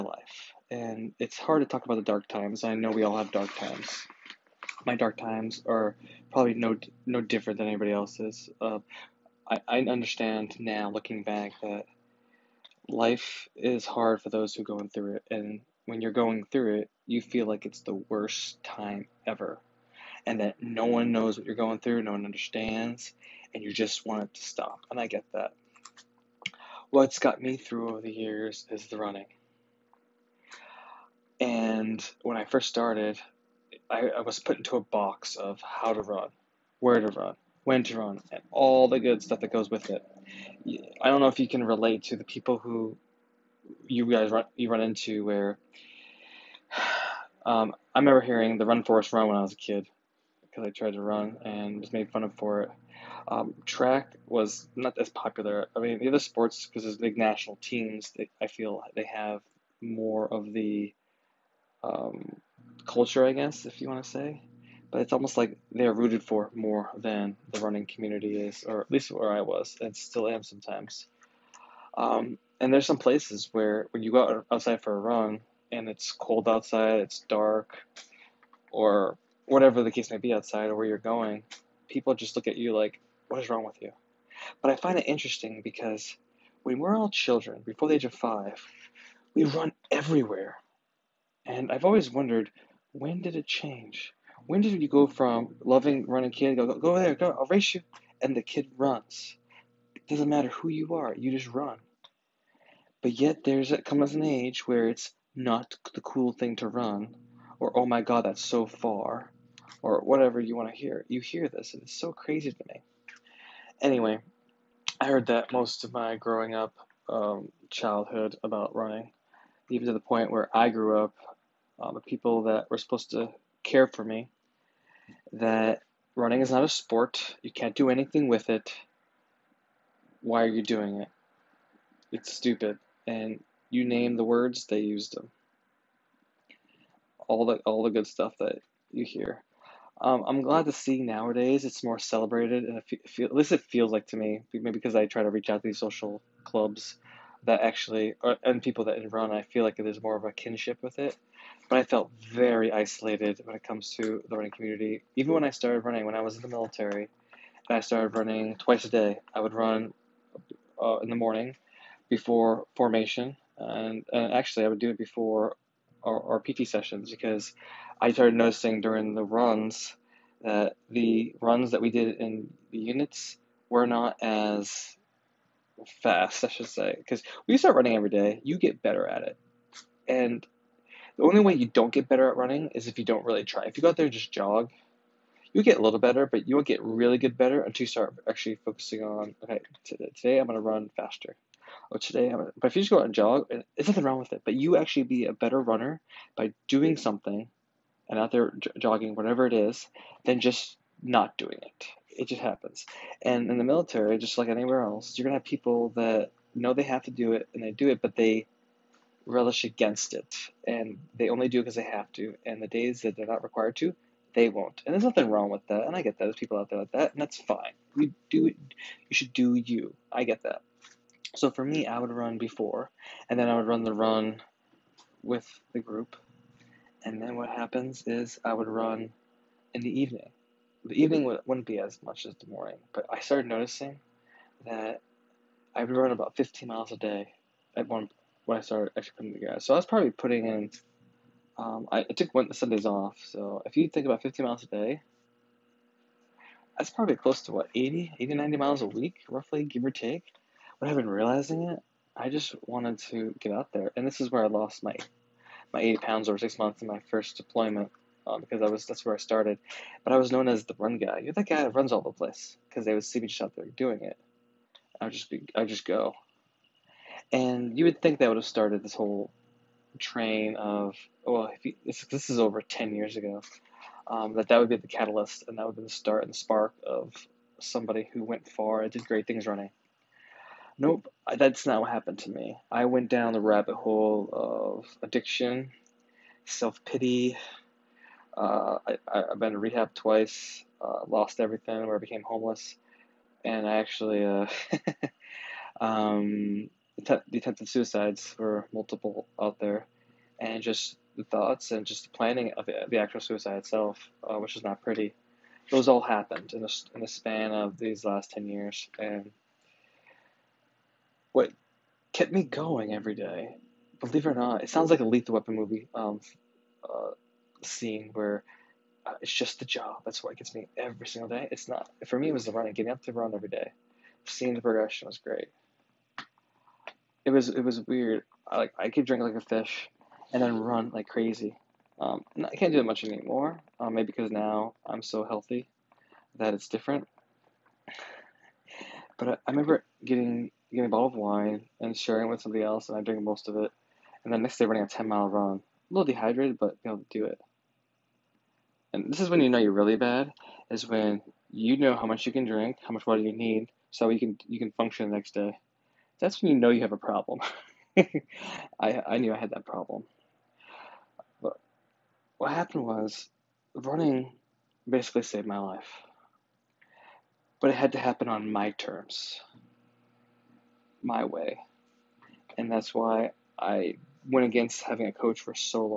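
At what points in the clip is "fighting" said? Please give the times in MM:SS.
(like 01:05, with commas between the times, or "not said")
not said.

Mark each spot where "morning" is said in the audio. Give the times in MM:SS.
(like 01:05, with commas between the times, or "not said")
02:41, 03:52.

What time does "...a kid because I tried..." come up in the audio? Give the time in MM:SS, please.
00:49.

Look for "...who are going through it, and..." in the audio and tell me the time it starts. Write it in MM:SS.
00:14.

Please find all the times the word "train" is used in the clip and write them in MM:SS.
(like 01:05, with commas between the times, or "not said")
04:29.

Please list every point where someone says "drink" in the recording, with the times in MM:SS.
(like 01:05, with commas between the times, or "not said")
05:29, 05:43, 05:52.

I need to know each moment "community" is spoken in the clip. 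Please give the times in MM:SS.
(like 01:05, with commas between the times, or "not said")
01:07, 02:34.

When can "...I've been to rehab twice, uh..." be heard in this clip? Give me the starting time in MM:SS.
04:49.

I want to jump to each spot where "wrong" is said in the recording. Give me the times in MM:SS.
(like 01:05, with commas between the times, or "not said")
01:23, 03:14, 03:35.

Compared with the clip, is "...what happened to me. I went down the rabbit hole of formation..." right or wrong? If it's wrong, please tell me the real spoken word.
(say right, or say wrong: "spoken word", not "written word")
wrong: "addiction", not "formation".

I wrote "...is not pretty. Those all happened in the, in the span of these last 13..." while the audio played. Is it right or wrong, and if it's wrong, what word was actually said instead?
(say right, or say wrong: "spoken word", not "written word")
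wrong: "10", not "13".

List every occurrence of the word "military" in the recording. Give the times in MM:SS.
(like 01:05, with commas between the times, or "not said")
02:36, 03:23.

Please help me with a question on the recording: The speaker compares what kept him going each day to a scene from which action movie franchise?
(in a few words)
Lethal Weapon.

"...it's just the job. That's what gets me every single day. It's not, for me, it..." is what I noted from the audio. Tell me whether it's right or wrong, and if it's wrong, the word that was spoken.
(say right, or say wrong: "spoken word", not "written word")
right.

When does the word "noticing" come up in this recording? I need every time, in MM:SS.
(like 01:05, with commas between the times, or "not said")
02:48, 03:53.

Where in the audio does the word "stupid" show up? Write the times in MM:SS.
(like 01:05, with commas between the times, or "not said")
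02:12.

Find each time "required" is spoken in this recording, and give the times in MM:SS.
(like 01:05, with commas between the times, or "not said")
03:33.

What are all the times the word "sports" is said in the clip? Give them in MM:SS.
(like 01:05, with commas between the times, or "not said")
00:56, 02:06.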